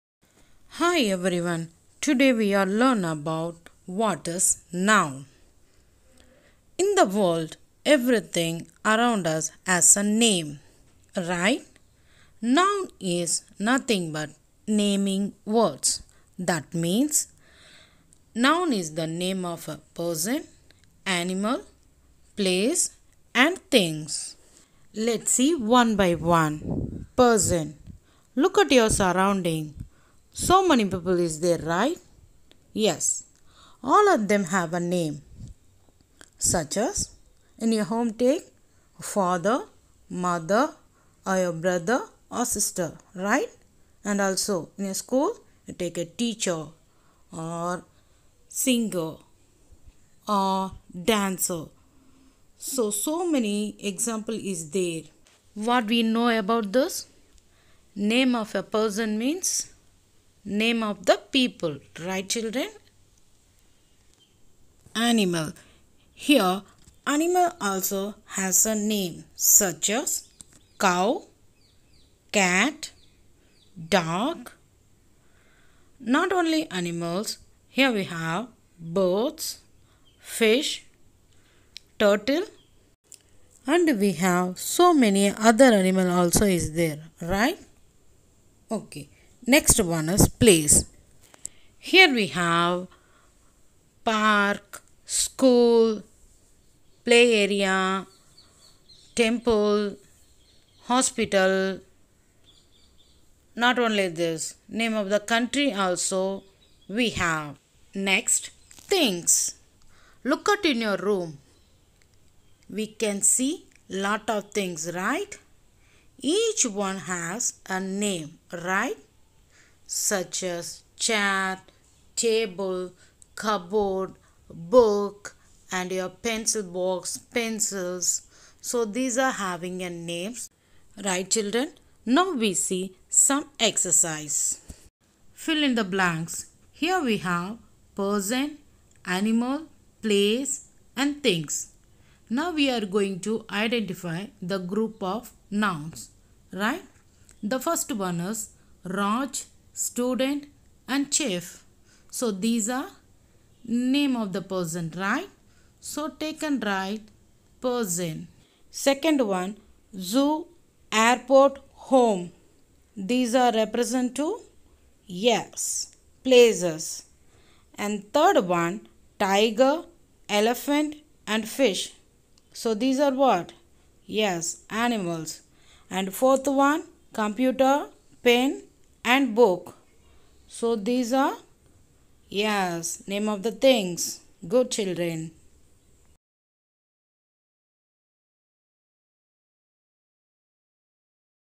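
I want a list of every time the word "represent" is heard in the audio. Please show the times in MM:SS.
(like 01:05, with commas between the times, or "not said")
02:43.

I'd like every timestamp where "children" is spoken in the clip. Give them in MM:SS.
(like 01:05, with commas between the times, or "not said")
01:02, 02:11, 03:04.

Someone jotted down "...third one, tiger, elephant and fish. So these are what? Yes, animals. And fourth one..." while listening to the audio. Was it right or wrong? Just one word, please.
right.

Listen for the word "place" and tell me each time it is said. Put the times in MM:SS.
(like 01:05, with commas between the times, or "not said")
00:22, 01:30, 02:20, 02:46.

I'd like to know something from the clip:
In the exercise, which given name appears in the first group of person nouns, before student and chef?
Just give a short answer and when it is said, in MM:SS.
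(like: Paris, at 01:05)
Raj, at 02:28.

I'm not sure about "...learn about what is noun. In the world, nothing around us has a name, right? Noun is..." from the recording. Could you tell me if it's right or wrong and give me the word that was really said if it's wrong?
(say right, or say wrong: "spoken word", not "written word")
wrong: "everything", not "nothing".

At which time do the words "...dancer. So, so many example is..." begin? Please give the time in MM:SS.
00:51.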